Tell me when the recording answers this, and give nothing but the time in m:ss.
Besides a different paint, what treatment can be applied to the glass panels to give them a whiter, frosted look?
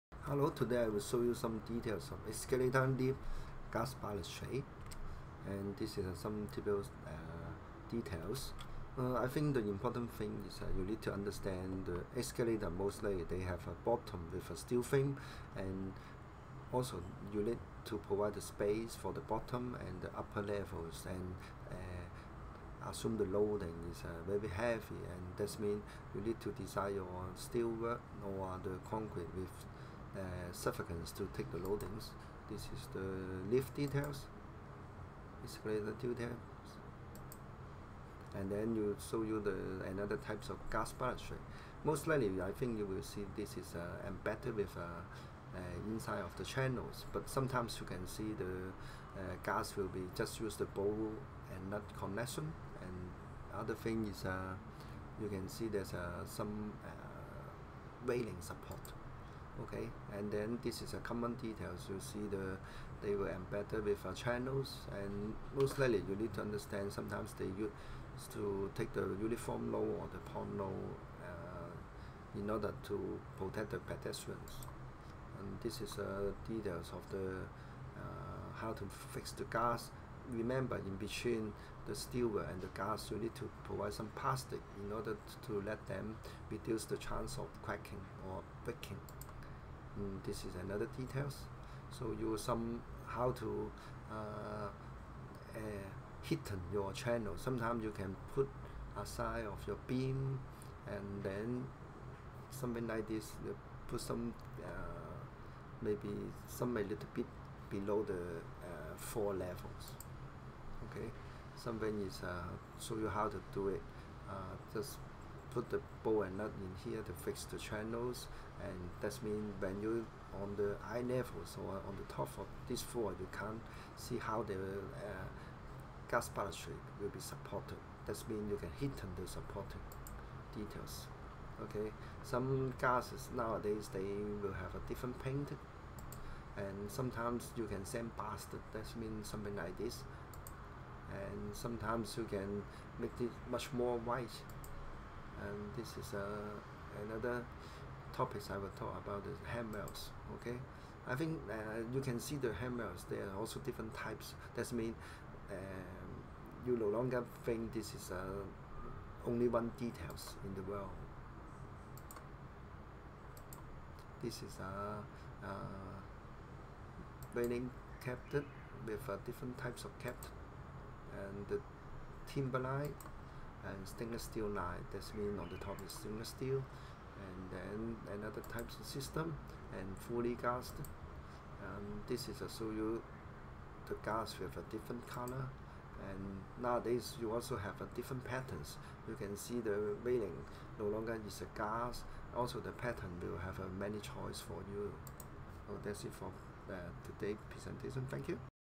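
2:17.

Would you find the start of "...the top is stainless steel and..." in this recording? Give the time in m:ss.
2:55.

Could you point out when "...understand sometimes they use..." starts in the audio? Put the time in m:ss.
1:06.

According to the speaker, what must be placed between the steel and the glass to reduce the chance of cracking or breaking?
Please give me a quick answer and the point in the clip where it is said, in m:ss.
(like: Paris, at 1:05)
plastic, at 1:24.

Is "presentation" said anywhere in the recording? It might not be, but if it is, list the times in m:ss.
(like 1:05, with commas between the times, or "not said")
3:17.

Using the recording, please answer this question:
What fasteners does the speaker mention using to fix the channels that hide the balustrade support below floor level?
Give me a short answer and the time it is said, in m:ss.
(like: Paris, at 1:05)
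bolt and nut, at 1:56.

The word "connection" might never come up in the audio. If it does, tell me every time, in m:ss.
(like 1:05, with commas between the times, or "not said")
0:51.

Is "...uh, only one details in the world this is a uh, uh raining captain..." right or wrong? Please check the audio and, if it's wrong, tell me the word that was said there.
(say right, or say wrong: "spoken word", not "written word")
right.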